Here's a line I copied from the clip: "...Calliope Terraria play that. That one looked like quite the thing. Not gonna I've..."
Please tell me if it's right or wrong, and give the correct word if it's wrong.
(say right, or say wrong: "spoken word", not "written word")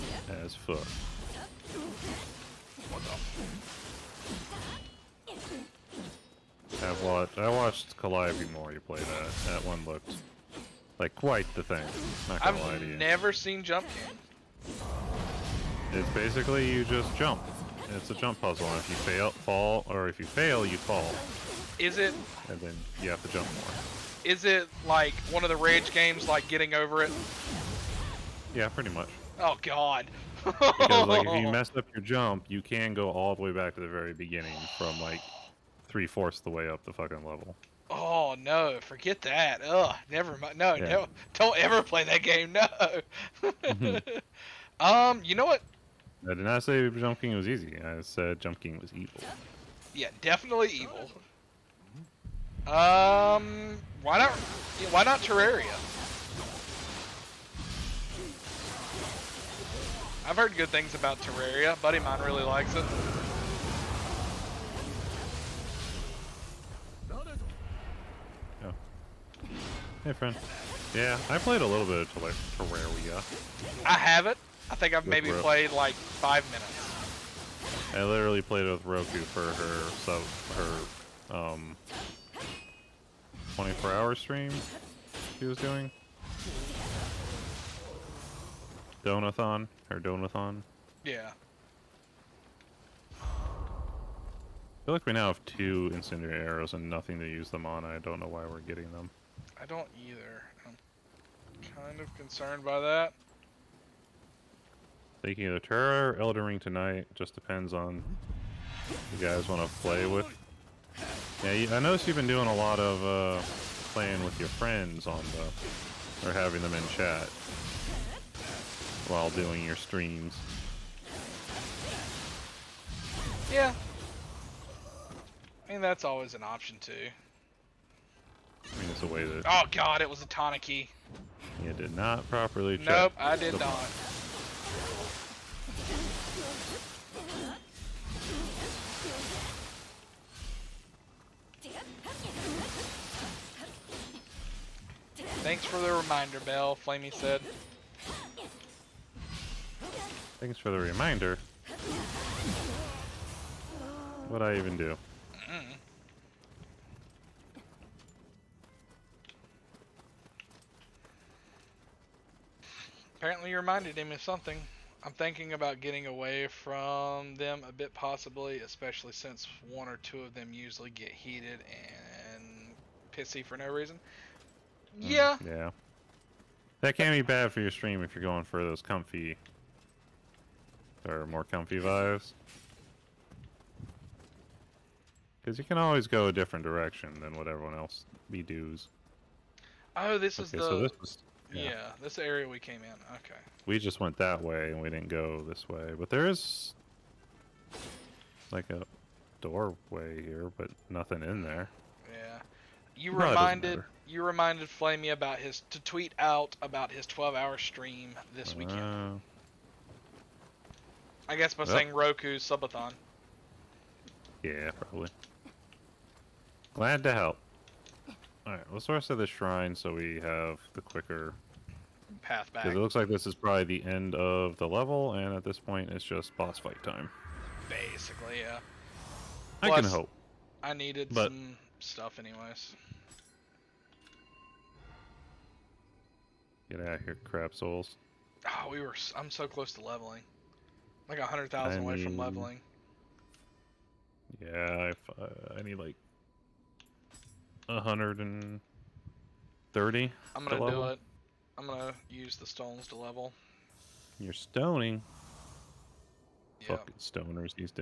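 wrong: "You", not "Terraria".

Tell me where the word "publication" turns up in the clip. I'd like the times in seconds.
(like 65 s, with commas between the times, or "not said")
not said.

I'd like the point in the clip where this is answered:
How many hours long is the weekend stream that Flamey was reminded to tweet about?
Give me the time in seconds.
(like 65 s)
207 s.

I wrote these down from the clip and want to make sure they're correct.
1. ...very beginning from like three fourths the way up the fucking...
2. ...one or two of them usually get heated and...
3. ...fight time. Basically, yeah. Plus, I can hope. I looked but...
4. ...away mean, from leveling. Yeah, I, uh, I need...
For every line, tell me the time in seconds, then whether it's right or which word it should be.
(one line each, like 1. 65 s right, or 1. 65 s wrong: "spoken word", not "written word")
1. 33 s right
2. 169 s right
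3. 226 s wrong: "needed", not "looked"
4. 241 s right.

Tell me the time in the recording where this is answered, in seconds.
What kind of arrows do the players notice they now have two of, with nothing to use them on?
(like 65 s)
95 s.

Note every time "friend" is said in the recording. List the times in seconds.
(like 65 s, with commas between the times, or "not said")
70 s, 114 s.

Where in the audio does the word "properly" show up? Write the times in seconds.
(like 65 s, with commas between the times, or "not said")
132 s.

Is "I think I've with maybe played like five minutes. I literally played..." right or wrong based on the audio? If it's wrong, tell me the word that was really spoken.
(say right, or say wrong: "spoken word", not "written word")
right.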